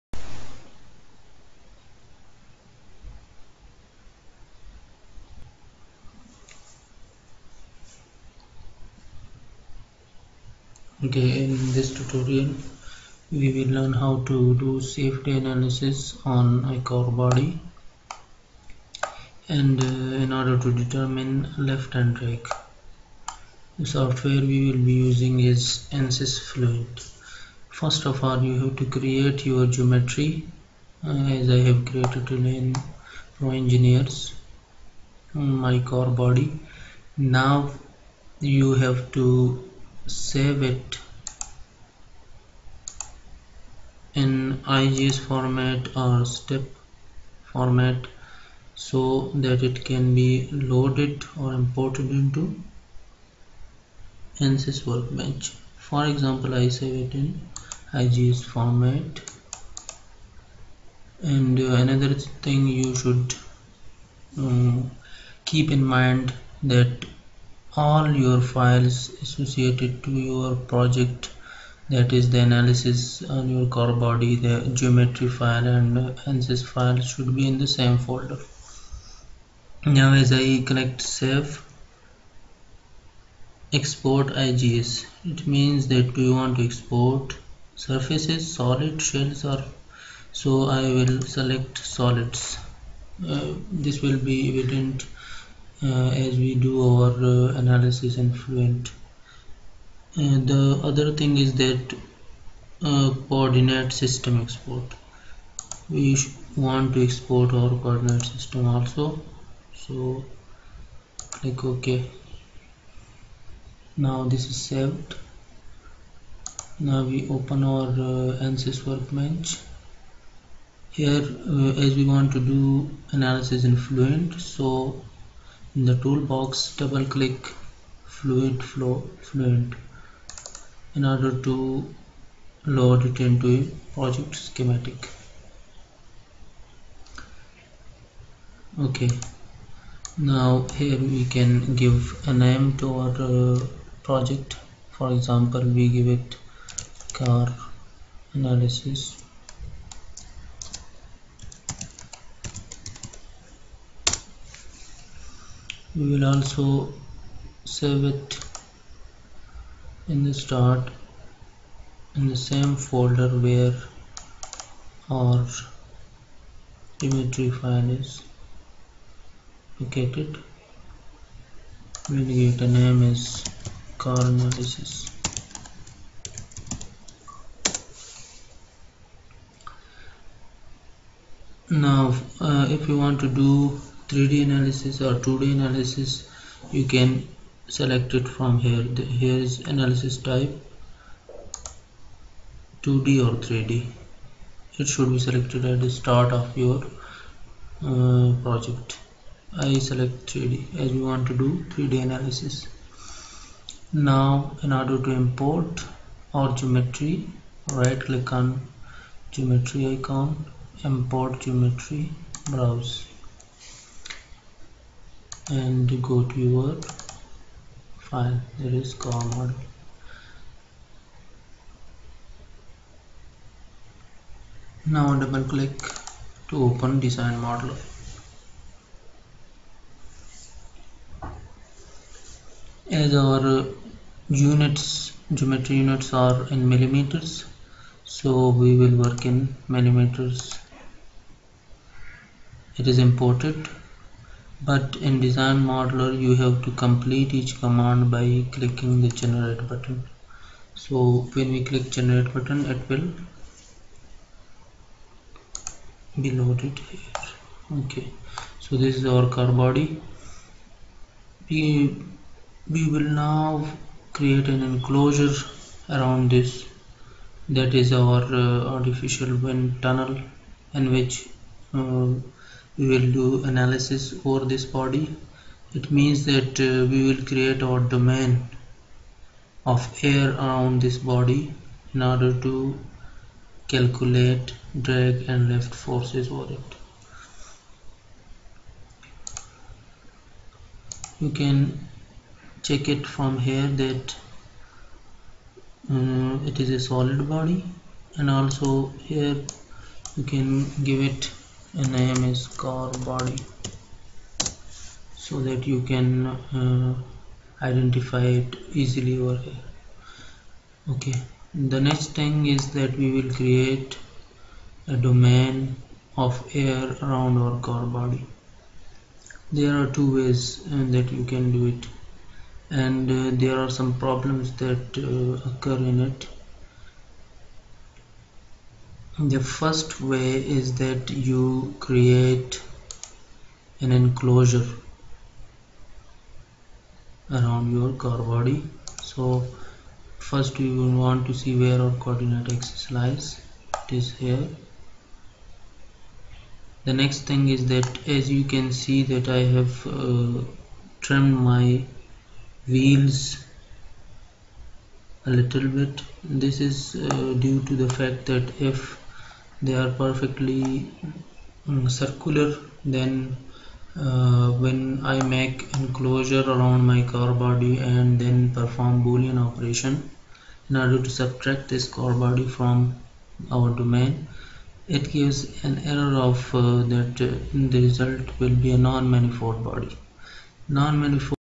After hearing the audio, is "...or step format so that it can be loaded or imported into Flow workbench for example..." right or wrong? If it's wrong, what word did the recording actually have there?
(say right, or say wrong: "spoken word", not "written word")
wrong: "ANSYS", not "Flow".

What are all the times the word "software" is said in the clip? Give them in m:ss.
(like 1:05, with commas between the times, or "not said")
0:23.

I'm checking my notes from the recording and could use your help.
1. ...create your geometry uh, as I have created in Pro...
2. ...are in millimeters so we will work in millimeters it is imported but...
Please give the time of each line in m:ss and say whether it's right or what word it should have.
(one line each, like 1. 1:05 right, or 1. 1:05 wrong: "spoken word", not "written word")
1. 0:28 right
2. 3:56 right.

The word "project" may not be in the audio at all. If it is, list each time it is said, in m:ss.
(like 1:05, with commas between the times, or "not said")
1:10, 2:13, 2:24, 3:18.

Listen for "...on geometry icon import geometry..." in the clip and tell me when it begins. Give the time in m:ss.
3:28.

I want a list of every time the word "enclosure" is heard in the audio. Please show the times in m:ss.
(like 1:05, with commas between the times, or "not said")
4:24, 5:33, 6:05.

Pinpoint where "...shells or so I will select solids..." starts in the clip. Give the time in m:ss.
1:29.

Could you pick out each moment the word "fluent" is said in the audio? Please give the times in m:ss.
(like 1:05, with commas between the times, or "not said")
0:26, 1:38, 2:03, 2:09.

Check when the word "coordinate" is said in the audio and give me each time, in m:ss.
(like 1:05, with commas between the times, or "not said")
1:43, 1:47, 5:42.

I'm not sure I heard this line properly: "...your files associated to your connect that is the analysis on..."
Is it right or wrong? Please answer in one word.
wrong.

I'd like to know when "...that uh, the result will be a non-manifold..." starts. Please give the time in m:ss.
6:16.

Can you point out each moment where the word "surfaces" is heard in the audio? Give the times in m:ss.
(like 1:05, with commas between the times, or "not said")
1:27.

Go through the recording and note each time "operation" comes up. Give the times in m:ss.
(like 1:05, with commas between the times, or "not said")
6:09.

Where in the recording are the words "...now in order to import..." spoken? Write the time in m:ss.
3:23.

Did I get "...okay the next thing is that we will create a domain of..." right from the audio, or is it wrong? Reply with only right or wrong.
right.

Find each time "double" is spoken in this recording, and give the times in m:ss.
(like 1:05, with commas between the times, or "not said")
2:06, 3:45.